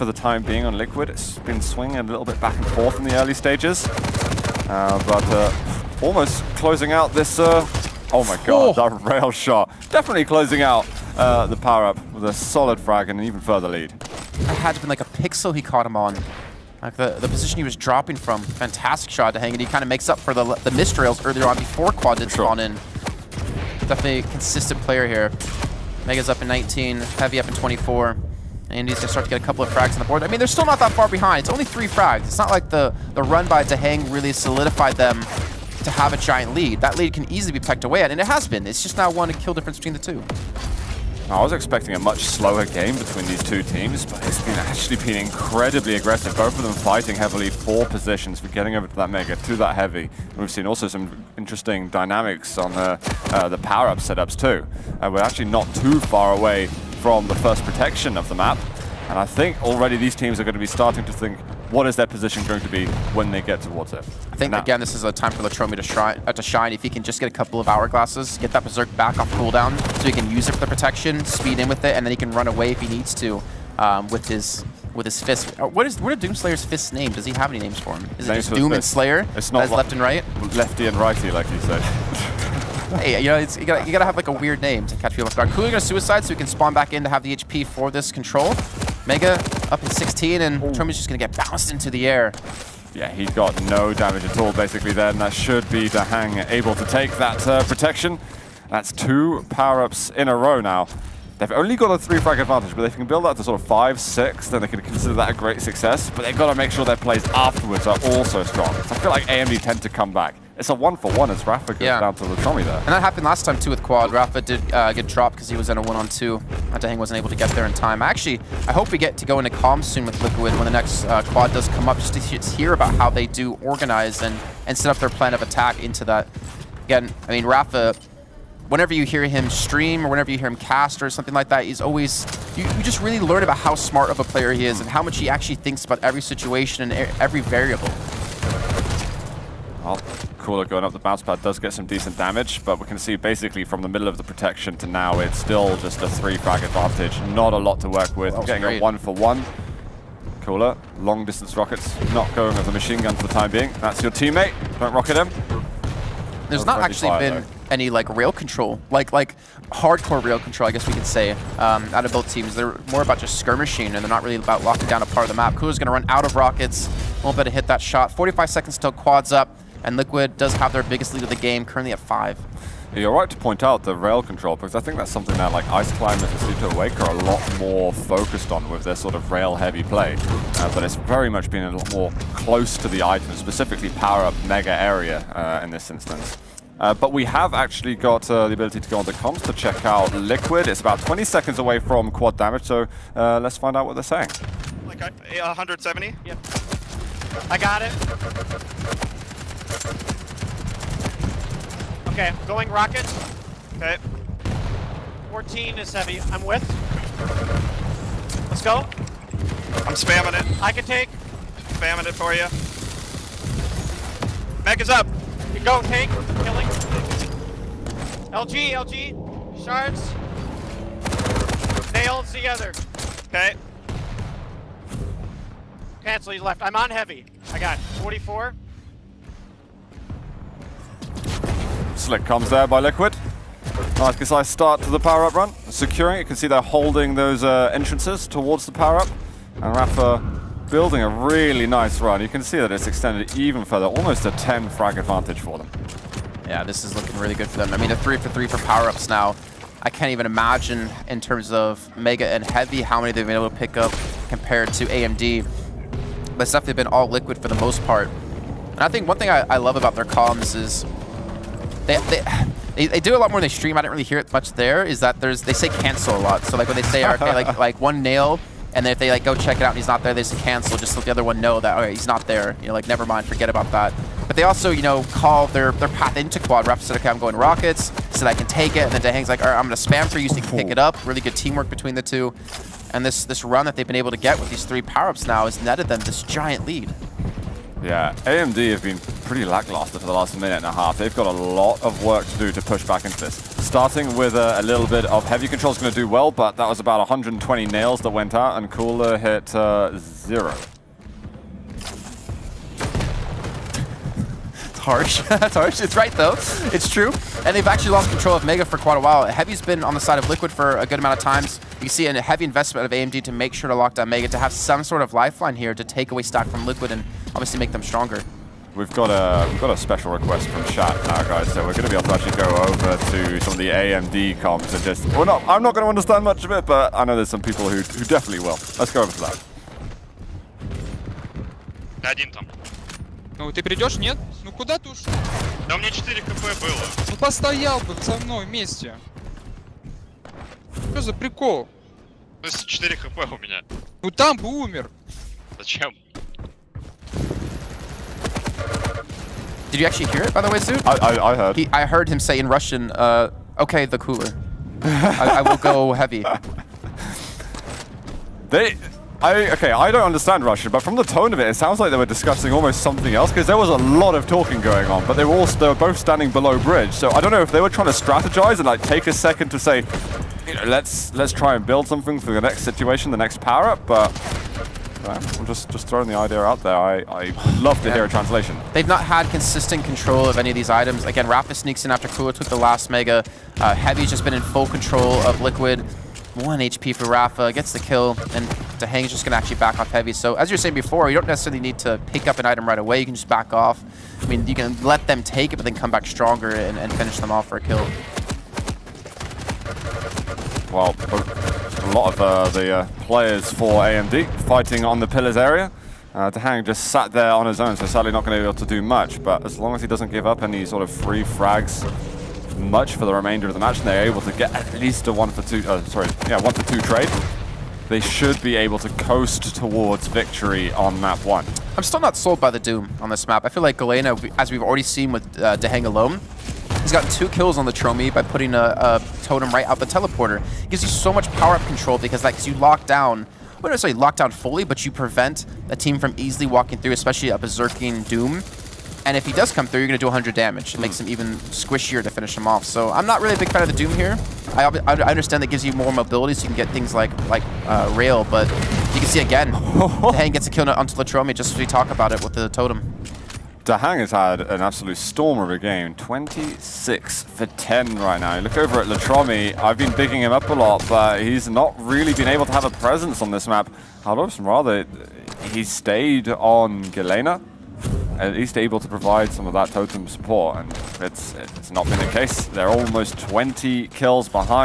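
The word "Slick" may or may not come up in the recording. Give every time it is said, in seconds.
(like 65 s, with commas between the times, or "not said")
232 s.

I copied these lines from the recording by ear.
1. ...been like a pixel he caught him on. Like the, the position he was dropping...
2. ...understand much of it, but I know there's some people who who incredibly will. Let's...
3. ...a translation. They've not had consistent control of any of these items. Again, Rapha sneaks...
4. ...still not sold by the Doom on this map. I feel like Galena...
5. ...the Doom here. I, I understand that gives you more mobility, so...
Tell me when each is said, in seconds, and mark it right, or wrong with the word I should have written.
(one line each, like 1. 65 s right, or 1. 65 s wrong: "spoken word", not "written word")
1. 14 s right
2. 325 s wrong: "definitely", not "incredibly"
3. 378 s right
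4. 421 s right
5. 443 s right.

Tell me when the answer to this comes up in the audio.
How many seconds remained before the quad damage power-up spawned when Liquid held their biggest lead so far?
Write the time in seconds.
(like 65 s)
168 s.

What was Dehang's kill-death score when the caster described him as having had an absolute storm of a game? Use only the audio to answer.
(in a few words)
26 for 10.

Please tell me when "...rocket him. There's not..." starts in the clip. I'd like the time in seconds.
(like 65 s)
154 s.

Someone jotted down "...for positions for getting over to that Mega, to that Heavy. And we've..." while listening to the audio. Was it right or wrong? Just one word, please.
right.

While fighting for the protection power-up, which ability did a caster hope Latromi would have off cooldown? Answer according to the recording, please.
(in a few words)
Berserk.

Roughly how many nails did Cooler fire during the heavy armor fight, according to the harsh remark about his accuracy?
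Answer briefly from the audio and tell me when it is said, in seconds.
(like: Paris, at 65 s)
120, at 296 s.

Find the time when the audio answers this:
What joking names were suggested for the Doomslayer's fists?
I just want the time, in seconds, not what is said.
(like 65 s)
80 s.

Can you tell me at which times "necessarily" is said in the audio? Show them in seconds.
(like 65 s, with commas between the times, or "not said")
391 s, 433 s.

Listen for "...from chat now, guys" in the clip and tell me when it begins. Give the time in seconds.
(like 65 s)
320 s.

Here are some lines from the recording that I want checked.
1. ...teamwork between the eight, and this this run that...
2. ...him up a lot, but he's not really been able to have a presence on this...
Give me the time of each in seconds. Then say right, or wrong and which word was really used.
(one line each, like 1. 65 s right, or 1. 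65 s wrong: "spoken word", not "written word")
1. 281 s wrong: "two", not "eight"
2. 460 s right.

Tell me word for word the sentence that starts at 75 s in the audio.
Uh, what is what are Doomslayer's fist name?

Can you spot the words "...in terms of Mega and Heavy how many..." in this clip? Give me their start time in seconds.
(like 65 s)
251 s.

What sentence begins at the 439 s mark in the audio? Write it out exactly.
And if he does come through, you're going to do 100 damage.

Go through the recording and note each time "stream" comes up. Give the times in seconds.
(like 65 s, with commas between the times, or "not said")
129 s, 263 s.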